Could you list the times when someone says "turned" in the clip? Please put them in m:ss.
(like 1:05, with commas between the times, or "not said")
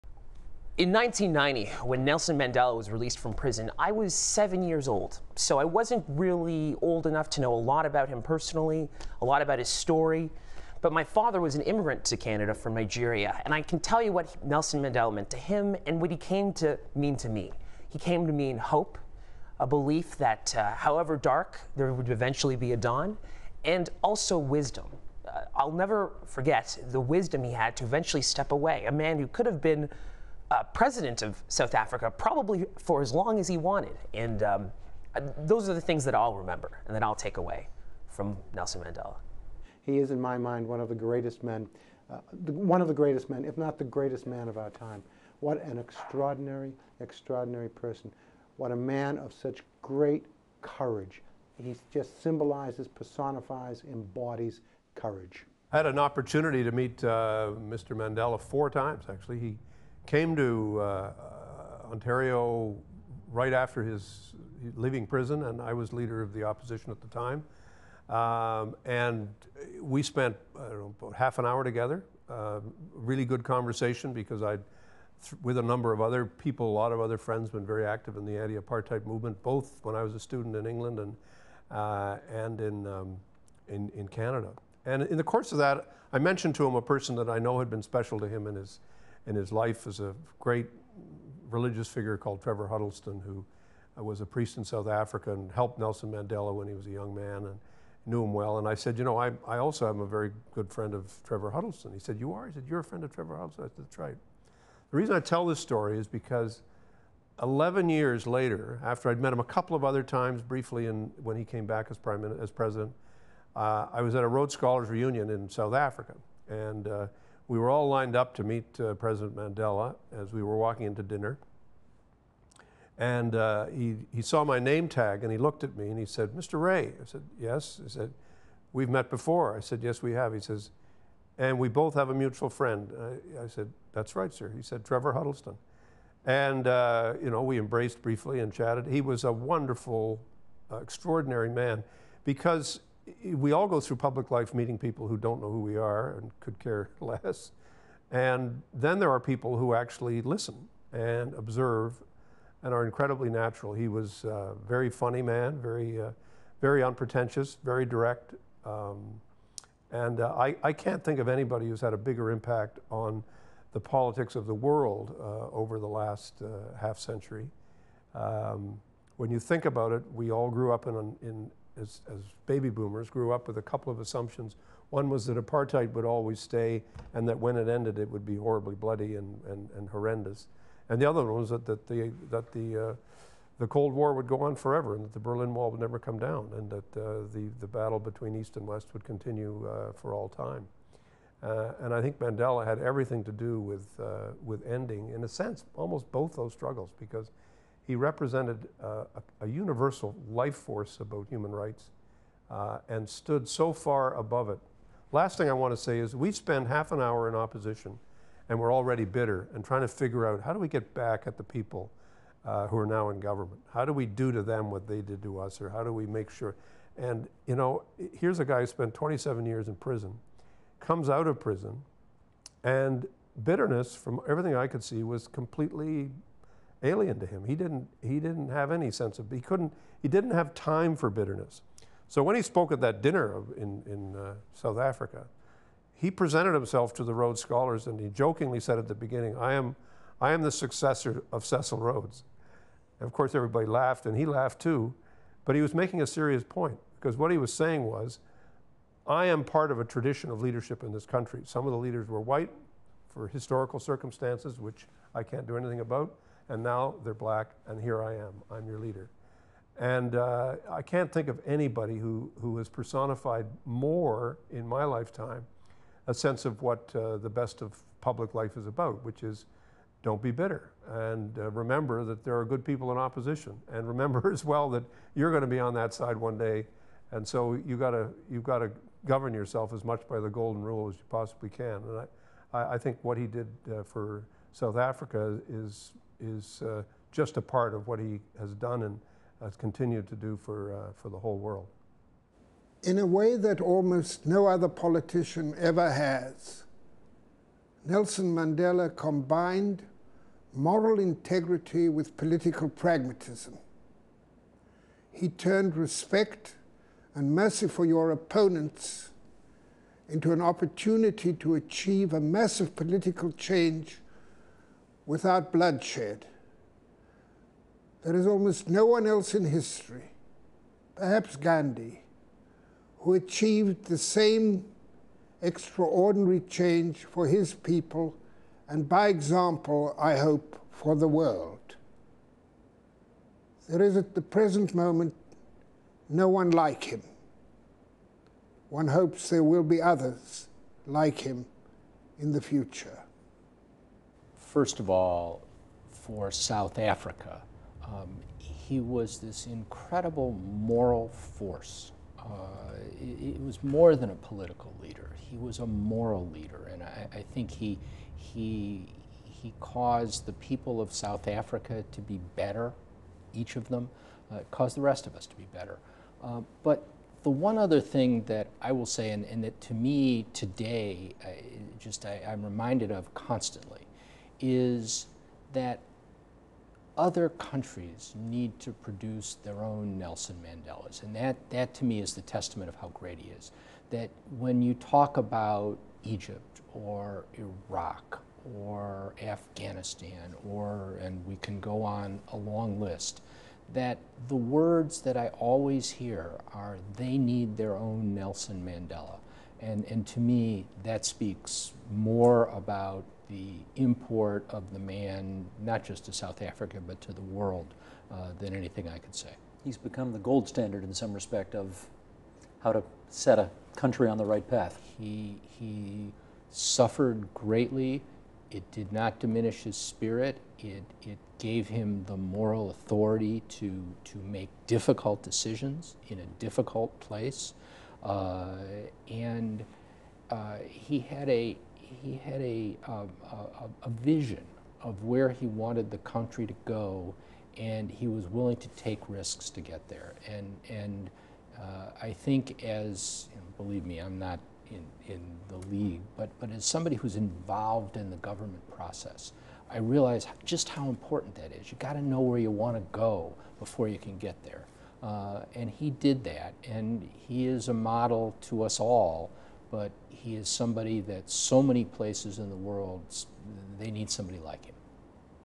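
5:05.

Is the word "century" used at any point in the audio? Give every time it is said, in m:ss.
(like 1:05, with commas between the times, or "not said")
2:46.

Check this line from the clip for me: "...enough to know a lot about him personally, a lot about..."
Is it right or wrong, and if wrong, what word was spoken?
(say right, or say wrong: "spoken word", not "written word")
right.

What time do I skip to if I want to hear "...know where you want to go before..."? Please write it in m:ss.
7:32.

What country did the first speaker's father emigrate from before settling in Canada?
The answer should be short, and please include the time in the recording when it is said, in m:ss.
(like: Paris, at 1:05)
Nigeria, at 0:12.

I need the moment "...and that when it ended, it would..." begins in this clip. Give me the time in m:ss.
2:57.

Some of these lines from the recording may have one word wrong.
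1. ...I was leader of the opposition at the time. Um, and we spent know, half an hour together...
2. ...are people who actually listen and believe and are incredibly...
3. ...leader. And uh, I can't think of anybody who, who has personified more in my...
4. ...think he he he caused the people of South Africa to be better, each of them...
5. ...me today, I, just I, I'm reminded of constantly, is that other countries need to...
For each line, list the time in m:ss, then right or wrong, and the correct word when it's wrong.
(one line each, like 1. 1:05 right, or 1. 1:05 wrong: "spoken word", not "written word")
1. 1:05 right
2. 2:29 wrong: "observe", not "believe"
3. 4:18 right
4. 5:57 right
5. 6:09 right.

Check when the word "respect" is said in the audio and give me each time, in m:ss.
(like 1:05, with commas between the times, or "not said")
5:05, 6:51.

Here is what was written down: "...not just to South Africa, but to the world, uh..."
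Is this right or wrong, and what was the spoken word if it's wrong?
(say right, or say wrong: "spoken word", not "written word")
right.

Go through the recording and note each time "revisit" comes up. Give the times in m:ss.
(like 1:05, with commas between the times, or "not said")
not said.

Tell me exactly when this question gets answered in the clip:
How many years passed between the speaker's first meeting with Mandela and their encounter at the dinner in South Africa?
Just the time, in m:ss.
1:47.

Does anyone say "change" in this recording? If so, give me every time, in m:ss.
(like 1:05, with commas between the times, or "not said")
5:13, 5:26.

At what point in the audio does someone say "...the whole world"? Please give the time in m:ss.
4:51.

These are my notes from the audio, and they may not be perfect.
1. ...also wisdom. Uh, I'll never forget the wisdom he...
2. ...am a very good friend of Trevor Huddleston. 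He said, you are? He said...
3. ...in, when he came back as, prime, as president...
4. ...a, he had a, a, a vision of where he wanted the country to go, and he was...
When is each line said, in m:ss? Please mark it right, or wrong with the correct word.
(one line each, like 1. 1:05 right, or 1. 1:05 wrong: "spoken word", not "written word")
1. 0:24 right
2. 1:39 right
3. 1:50 right
4. 7:11 right.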